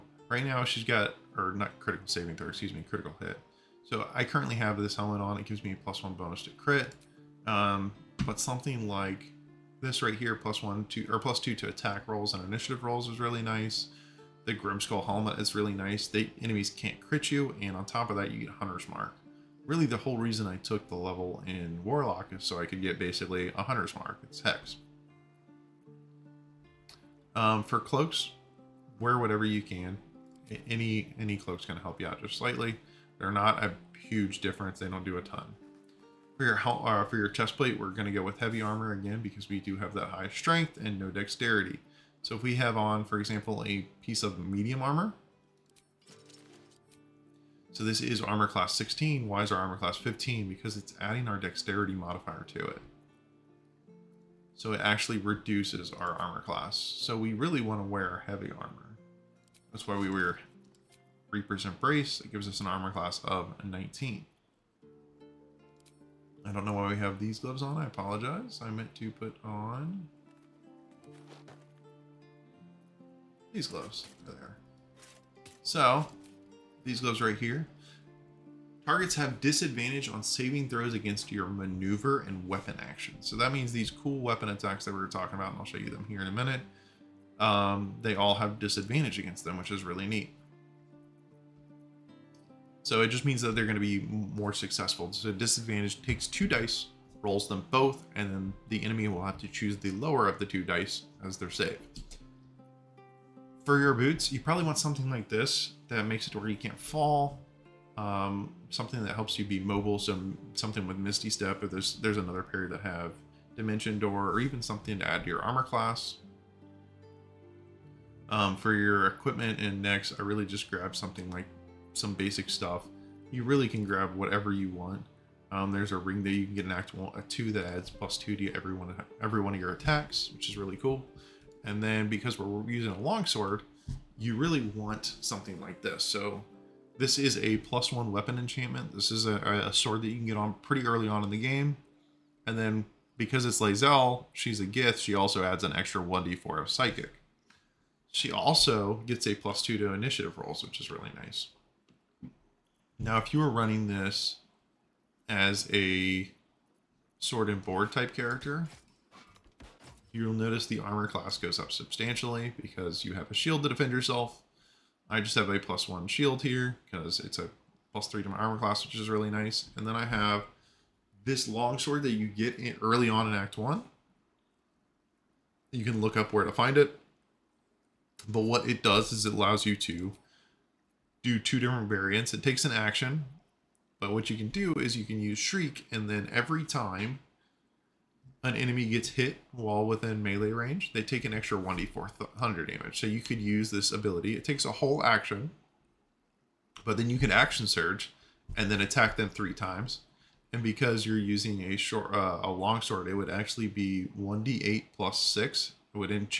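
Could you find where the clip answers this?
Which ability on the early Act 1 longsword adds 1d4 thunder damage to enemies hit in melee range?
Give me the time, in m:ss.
3:05.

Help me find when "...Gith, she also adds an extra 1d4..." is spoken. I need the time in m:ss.
2:24.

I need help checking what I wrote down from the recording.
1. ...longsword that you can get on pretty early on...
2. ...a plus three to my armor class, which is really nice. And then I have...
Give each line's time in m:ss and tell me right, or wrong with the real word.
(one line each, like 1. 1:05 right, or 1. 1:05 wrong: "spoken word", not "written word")
1. 2:19 wrong: "sword", not "longsword"
2. 2:47 right.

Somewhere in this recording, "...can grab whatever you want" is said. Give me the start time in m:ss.
2:03.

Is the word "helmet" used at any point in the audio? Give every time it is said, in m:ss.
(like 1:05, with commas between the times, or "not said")
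0:04, 0:15.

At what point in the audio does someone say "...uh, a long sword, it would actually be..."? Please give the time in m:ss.
3:22.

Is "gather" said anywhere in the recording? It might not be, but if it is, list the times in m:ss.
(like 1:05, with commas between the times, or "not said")
not said.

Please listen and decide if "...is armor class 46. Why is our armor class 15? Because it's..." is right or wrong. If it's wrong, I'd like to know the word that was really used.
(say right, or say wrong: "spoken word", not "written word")
wrong: "16", not "46".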